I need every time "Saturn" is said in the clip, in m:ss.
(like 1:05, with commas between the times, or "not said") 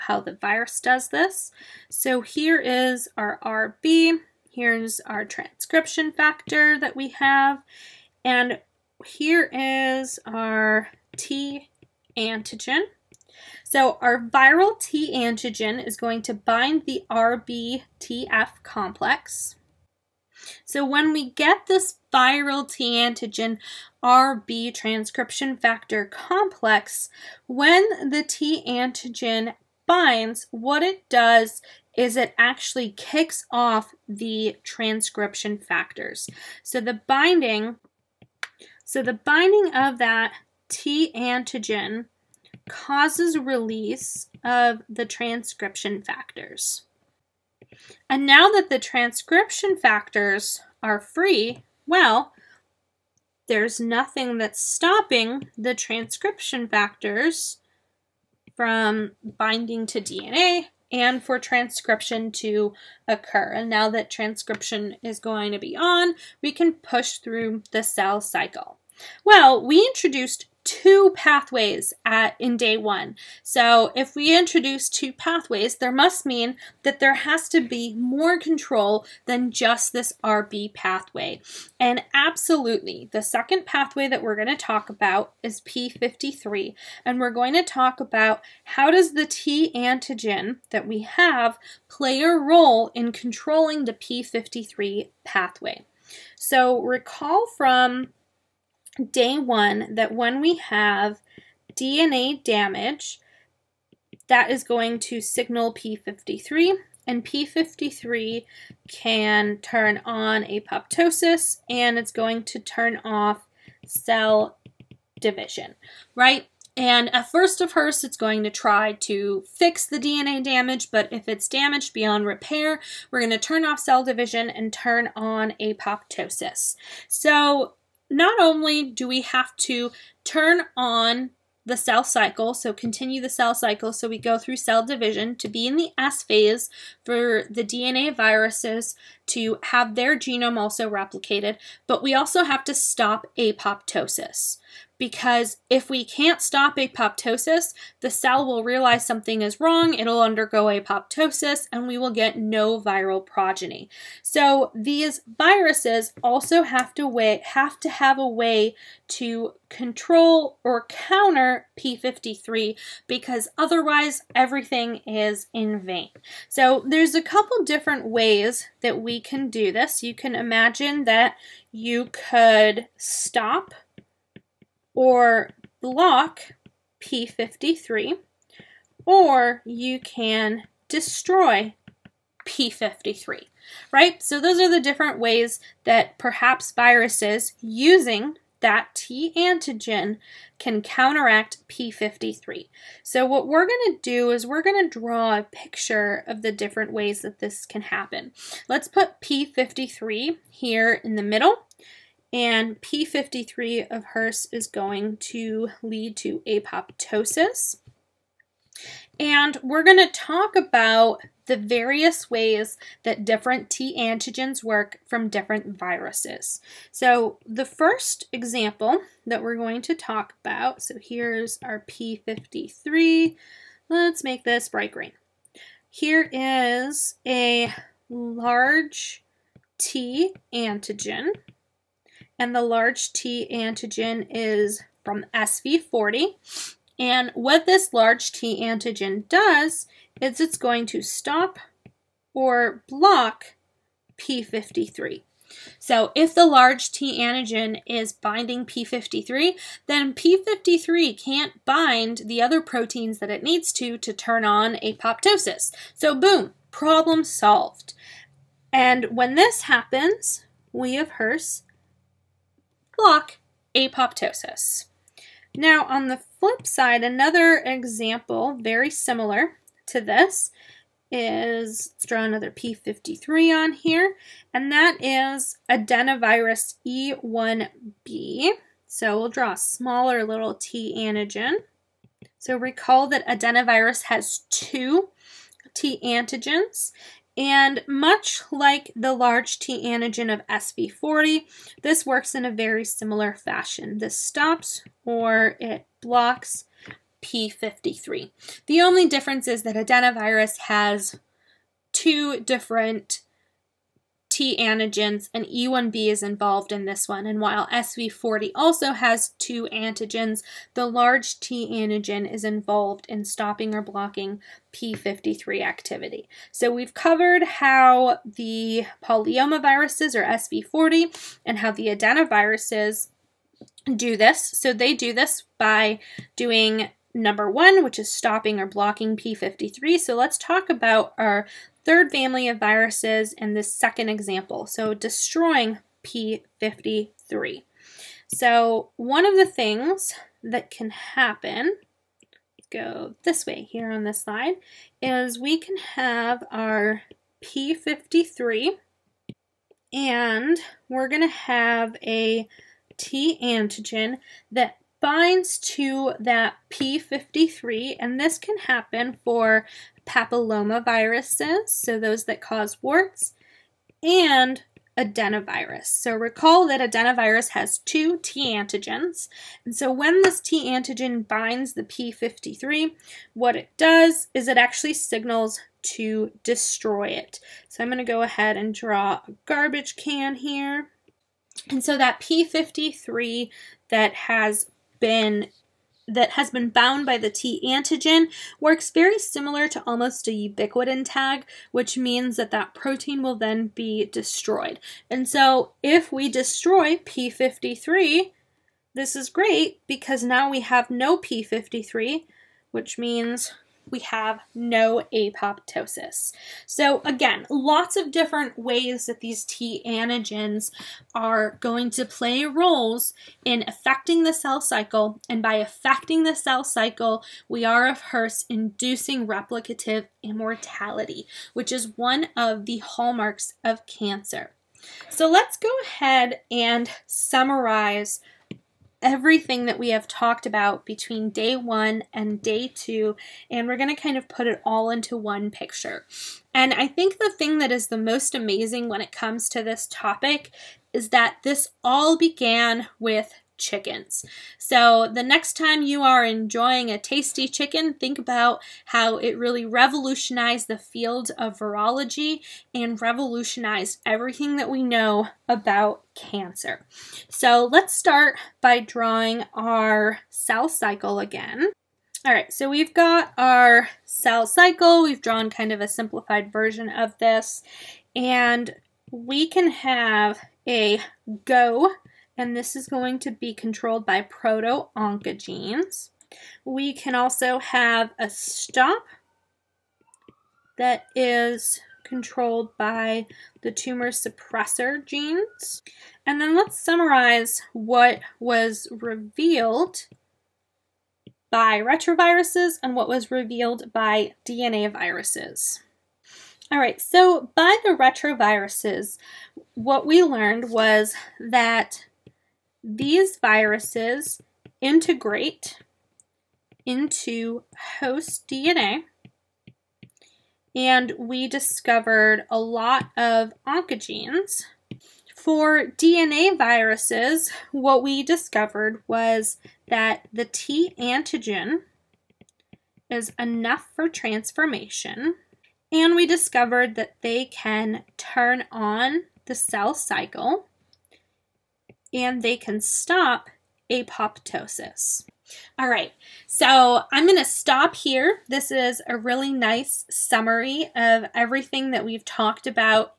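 not said.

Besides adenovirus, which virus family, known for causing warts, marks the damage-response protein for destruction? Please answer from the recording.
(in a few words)
Papillomaviruses.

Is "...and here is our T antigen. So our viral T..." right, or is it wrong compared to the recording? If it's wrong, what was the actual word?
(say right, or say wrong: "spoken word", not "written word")
right.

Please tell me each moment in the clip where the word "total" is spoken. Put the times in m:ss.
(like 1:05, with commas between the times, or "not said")
not said.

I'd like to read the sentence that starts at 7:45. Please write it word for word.
We've drawn kind of a simplified version of this.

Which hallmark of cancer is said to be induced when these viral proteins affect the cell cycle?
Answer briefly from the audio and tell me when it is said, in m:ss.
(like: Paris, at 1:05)
Replicative immortality, at 6:59.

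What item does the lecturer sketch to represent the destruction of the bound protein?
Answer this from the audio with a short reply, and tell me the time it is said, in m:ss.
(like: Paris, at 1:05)
A garbage can, at 6:19.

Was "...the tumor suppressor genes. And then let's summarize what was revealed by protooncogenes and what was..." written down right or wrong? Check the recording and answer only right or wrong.
wrong.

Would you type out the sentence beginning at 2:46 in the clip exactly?
So there's a couple different ways that we can do this.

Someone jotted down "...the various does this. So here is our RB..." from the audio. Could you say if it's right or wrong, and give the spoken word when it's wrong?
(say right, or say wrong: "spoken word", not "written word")
wrong: "virus", not "various".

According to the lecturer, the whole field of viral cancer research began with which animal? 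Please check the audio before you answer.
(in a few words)
Chickens.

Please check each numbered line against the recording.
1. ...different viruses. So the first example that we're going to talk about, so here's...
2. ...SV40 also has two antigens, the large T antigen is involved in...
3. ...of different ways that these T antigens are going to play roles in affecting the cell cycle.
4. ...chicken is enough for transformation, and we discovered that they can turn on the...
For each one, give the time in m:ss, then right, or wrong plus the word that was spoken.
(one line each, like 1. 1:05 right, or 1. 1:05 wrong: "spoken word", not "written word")
1. 3:35 right
2. 5:07 right
3. 6:47 right
4. 8:40 wrong: "antigen", not "chicken".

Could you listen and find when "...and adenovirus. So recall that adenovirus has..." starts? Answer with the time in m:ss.
6:04.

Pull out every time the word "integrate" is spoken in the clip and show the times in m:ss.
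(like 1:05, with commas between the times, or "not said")
8:24.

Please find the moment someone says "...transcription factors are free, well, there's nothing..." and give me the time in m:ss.
0:48.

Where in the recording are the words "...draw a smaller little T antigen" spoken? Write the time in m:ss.
4:39.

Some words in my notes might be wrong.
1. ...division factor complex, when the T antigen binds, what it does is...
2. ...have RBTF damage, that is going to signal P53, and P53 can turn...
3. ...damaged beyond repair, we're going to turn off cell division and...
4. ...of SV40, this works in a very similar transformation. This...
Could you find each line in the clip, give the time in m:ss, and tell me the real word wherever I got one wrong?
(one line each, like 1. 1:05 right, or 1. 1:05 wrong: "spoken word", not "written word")
1. 0:24 wrong: "transcription", not "division"
2. 1:40 wrong: "DNA", not "RBTF"
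3. 2:01 right
4. 4:50 wrong: "fashion", not "transformation".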